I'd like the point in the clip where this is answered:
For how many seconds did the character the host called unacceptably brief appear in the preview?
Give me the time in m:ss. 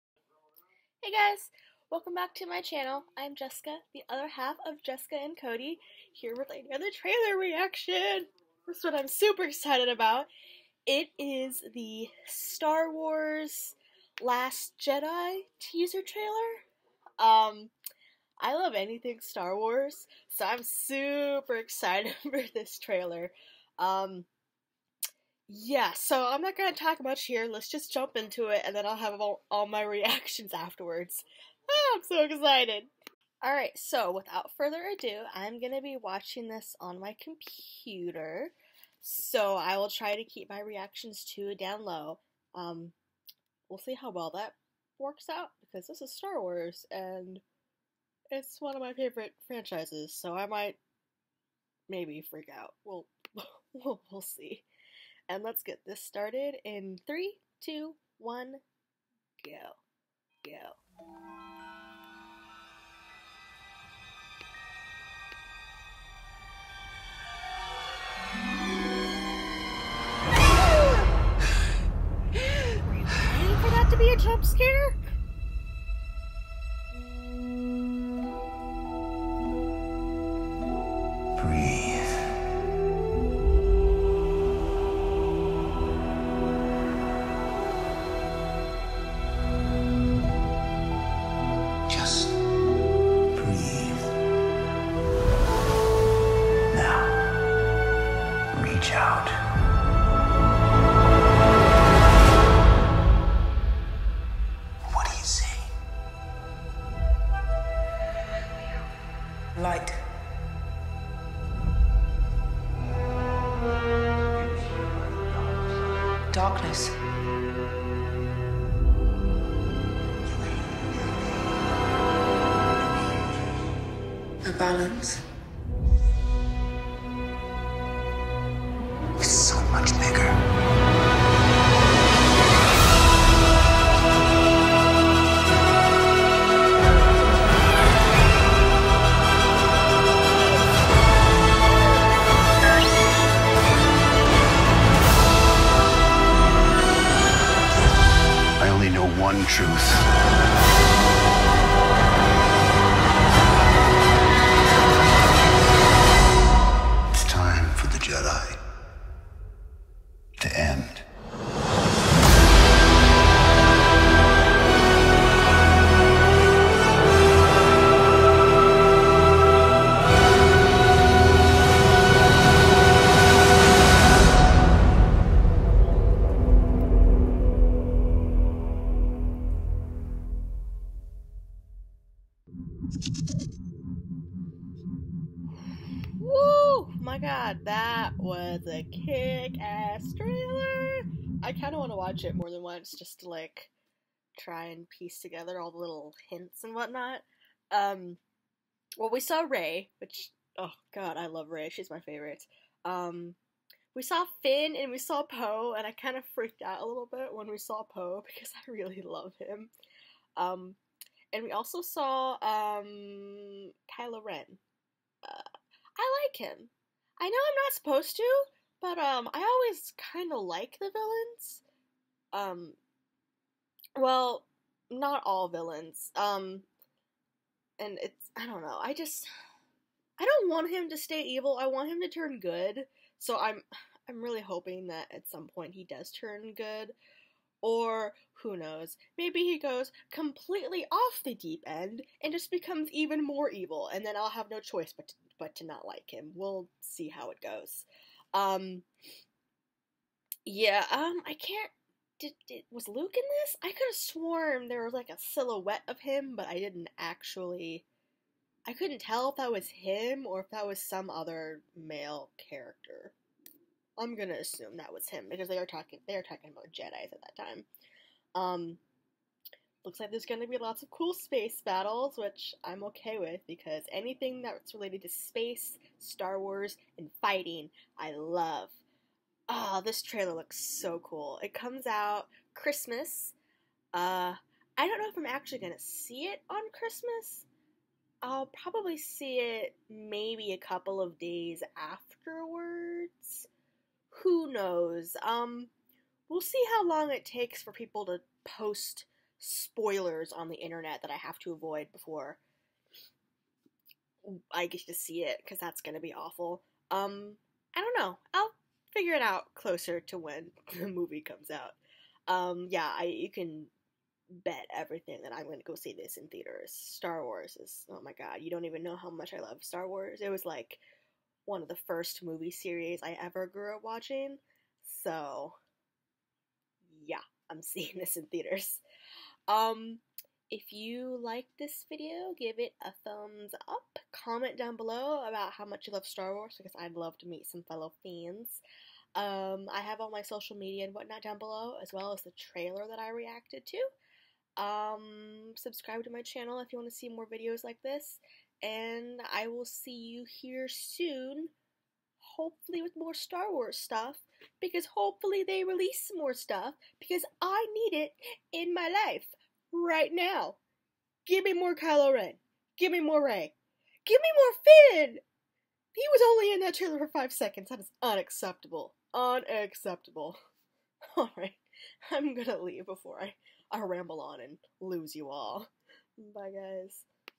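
6:07.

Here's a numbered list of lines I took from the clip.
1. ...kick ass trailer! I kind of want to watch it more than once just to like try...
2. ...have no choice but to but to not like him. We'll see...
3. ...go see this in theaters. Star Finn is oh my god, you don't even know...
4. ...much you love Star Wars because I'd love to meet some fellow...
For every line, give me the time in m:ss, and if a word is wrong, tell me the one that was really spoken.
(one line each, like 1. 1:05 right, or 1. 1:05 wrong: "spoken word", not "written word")
1. 3:08 right
2. 4:04 right
3. 5:15 wrong: "Wars", not "Finn"
4. 5:35 right.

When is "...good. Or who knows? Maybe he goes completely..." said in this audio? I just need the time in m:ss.
3:56.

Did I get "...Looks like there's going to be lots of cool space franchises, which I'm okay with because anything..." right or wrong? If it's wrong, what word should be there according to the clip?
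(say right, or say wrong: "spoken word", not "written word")
wrong: "battles", not "franchises".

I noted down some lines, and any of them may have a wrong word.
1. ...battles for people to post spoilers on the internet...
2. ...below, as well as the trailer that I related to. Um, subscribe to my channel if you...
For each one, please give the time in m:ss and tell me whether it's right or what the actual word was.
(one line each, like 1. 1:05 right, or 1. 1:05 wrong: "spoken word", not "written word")
1. 4:57 wrong: "takes", not "battles"
2. 5:41 wrong: "reacted", not "related".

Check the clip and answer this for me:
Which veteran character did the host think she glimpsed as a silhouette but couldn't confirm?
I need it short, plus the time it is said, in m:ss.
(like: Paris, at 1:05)
Luke, at 4:12.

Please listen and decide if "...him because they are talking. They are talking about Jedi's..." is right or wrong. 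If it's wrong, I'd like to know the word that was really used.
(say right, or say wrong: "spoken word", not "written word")
right.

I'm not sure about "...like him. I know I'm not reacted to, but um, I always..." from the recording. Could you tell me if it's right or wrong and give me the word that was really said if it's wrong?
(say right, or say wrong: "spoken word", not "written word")
wrong: "supposed", not "reacted".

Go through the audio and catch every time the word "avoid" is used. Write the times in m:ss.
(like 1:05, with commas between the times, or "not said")
5:01.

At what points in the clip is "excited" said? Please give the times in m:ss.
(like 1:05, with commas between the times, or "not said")
0:09, 0:21, 0:32.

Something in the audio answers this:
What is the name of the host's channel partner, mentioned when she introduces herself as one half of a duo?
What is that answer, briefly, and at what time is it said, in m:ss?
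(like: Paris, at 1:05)
Cody, at 0:05.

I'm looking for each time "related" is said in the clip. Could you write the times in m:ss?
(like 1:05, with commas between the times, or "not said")
4:34.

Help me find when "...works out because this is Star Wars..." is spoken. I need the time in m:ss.
0:44.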